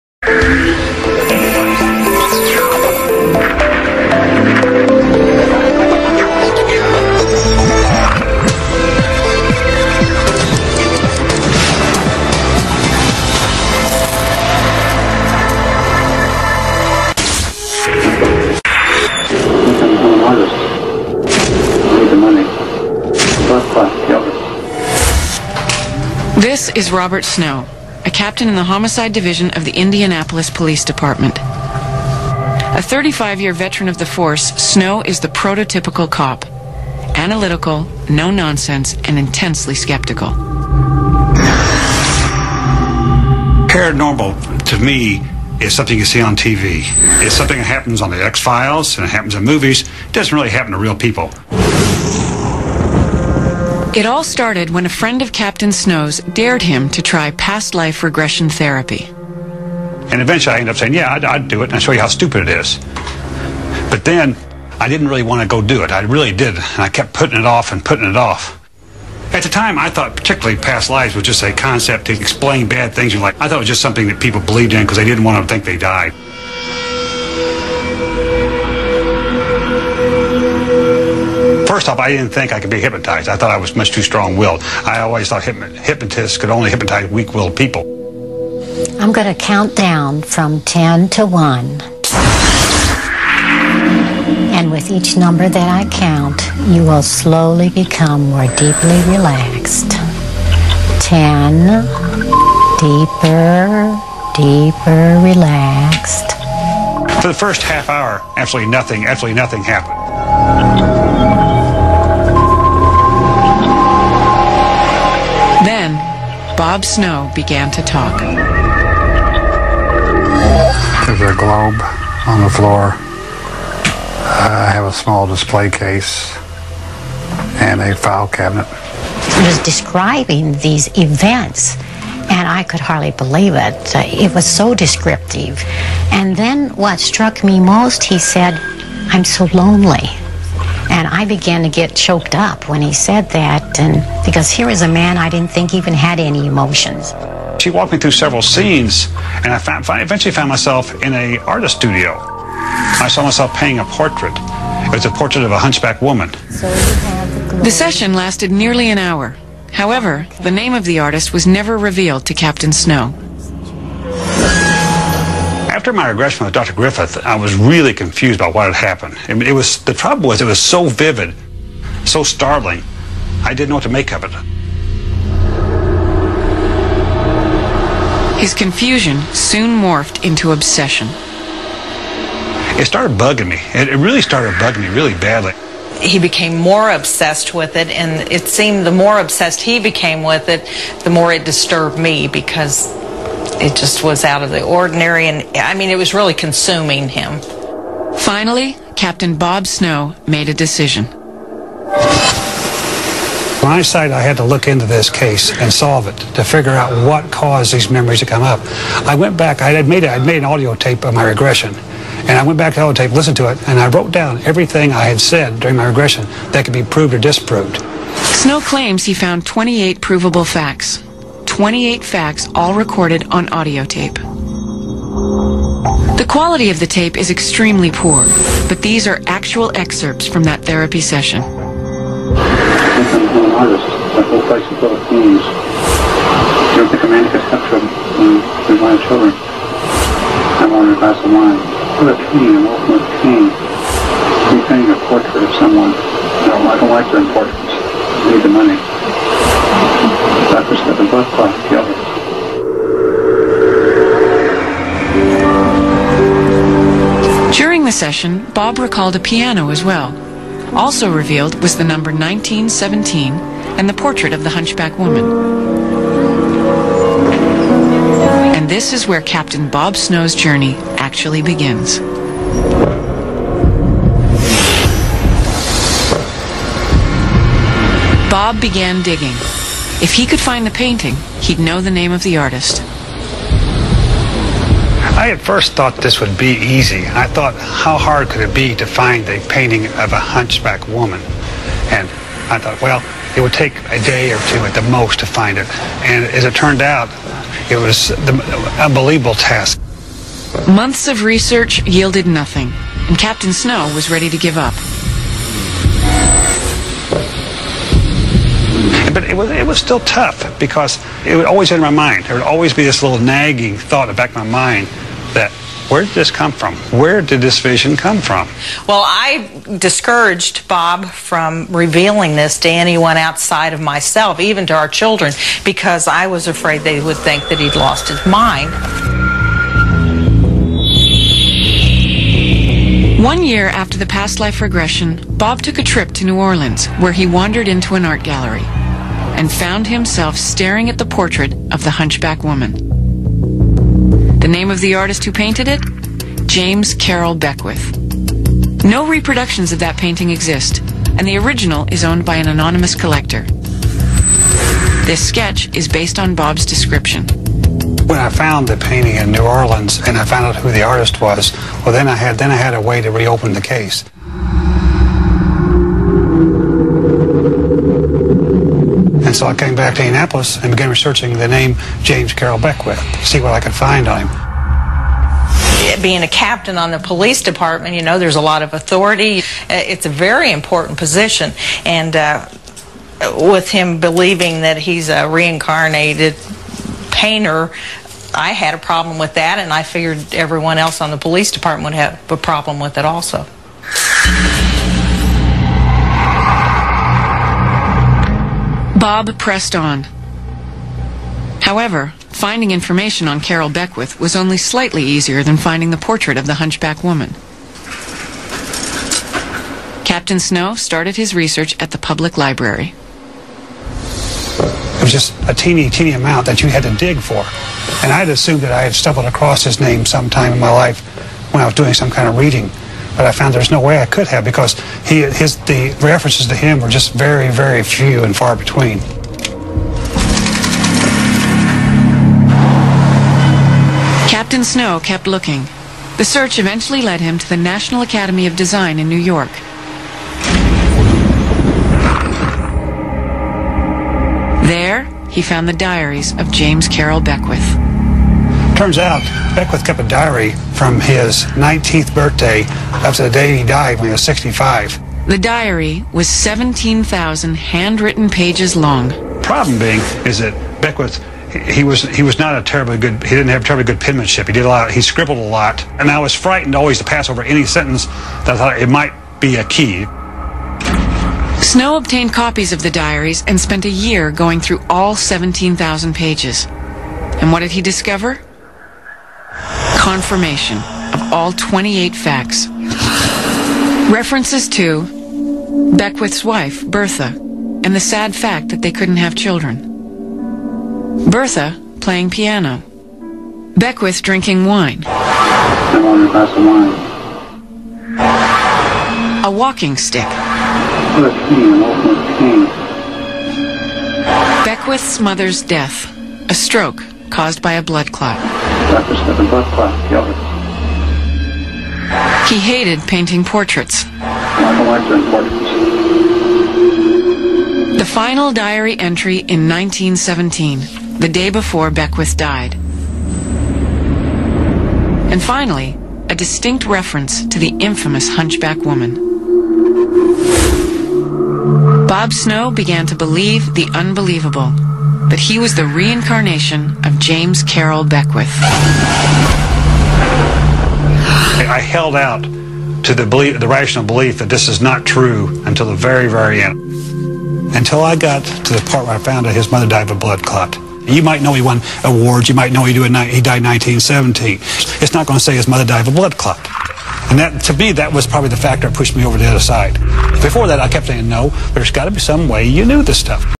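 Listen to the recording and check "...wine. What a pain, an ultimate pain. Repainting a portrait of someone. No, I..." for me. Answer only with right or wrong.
right.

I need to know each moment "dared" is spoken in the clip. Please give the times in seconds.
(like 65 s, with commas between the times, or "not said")
56 s.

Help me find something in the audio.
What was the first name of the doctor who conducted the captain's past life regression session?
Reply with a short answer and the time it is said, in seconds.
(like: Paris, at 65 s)
Griffith, at 166 s.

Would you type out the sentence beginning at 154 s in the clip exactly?
It was a portrait of a hunchback woman.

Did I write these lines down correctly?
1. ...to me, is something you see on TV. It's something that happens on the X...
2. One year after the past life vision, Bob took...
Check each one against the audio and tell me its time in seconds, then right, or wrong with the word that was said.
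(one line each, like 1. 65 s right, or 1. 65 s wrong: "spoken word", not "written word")
1. 44 s right
2. 333 s wrong: "regression", not "vision".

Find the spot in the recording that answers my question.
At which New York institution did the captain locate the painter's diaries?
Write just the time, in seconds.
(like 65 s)
437 s.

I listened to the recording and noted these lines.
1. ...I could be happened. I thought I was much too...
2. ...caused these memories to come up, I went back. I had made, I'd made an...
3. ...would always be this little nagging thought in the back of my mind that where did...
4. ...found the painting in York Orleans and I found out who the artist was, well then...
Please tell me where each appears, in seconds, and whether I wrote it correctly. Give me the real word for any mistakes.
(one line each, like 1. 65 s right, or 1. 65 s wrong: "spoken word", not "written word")
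1. 82 s wrong: "hypnotized", not "happened"
2. 207 s right
3. 312 s right
4. 358 s wrong: "New", not "York".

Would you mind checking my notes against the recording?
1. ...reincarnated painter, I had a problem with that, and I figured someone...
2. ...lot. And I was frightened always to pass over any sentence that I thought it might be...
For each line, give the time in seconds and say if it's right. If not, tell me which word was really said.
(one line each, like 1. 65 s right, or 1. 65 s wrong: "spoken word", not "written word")
1. 385 s wrong: "everyone", not "someone"
2. 465 s right.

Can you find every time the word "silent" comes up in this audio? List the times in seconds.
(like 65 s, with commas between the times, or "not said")
not said.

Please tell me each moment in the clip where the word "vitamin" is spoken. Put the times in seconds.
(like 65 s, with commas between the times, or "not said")
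not said.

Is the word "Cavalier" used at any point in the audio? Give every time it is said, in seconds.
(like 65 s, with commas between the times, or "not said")
not said.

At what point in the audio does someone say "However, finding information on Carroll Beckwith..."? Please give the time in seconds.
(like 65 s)
401 s.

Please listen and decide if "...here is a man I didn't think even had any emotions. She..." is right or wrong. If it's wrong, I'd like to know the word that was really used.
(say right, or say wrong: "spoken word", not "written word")
right.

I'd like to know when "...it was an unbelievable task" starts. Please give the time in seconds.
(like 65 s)
297 s.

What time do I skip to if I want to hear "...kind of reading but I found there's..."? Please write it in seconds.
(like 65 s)
422 s.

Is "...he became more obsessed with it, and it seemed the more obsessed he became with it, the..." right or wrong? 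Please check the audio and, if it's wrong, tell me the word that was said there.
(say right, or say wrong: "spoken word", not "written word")
right.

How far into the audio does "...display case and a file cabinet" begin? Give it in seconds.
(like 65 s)
125 s.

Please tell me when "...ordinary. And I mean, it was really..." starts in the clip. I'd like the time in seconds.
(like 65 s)
194 s.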